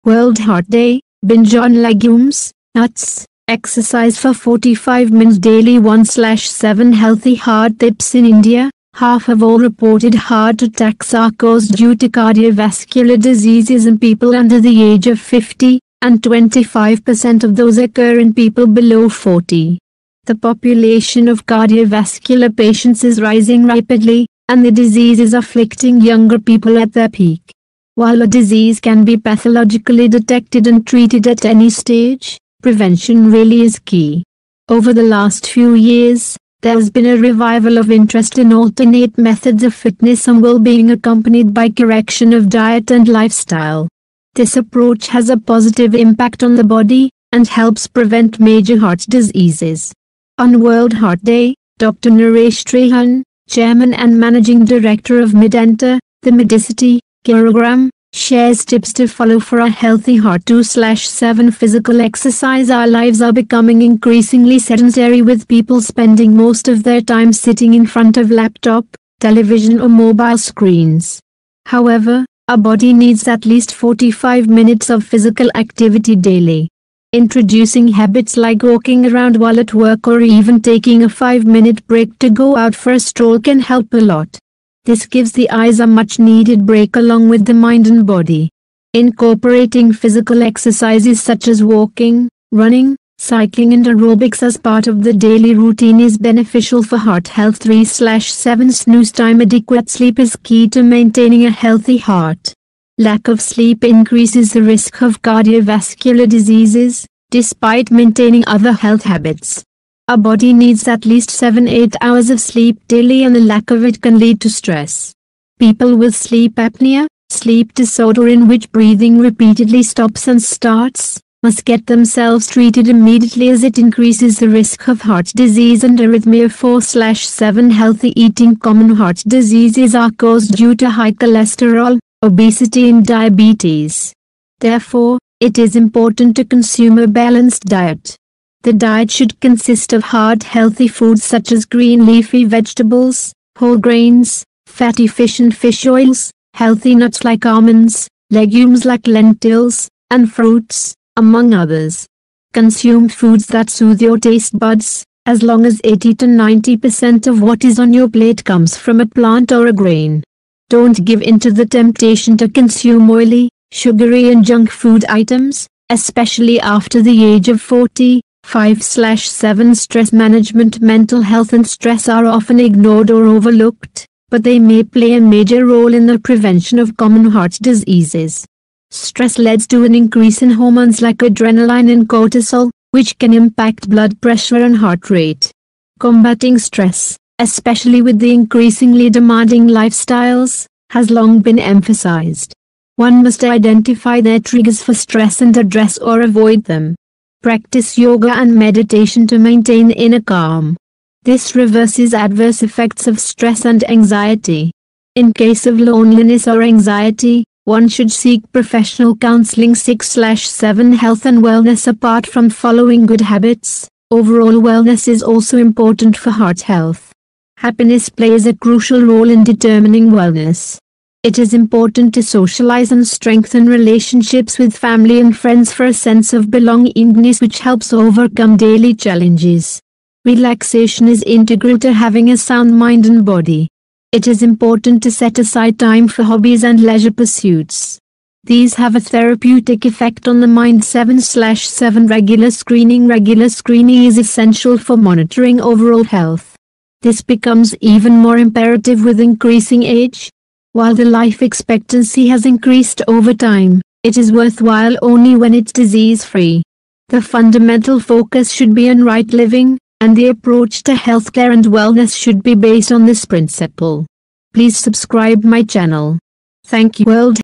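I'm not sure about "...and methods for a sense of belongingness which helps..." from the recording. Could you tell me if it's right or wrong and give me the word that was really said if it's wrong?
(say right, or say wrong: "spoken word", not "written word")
wrong: "friends", not "methods".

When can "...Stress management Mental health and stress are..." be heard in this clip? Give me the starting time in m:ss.
2:49.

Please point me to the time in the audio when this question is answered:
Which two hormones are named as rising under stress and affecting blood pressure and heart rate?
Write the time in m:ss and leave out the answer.
3:01.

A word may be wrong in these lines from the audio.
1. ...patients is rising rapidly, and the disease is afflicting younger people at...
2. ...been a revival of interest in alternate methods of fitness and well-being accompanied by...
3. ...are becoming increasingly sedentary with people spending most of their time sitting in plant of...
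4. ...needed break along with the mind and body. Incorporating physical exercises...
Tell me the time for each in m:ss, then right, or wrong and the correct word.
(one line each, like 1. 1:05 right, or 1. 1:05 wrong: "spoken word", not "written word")
1. 0:22 right
2. 0:36 right
3. 1:03 wrong: "front", not "plant"
4. 1:26 right.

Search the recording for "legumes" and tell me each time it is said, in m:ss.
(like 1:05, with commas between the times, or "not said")
0:01, 2:28.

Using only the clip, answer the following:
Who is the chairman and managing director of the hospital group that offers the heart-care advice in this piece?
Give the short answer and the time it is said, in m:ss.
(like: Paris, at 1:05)
Naresh Trehan, at 0:52.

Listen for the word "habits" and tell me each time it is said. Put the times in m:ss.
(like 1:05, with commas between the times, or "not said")
1:17, 1:49, 3:33.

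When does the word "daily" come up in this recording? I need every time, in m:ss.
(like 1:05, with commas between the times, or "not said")
0:05, 1:16, 1:35, 1:52, 3:48.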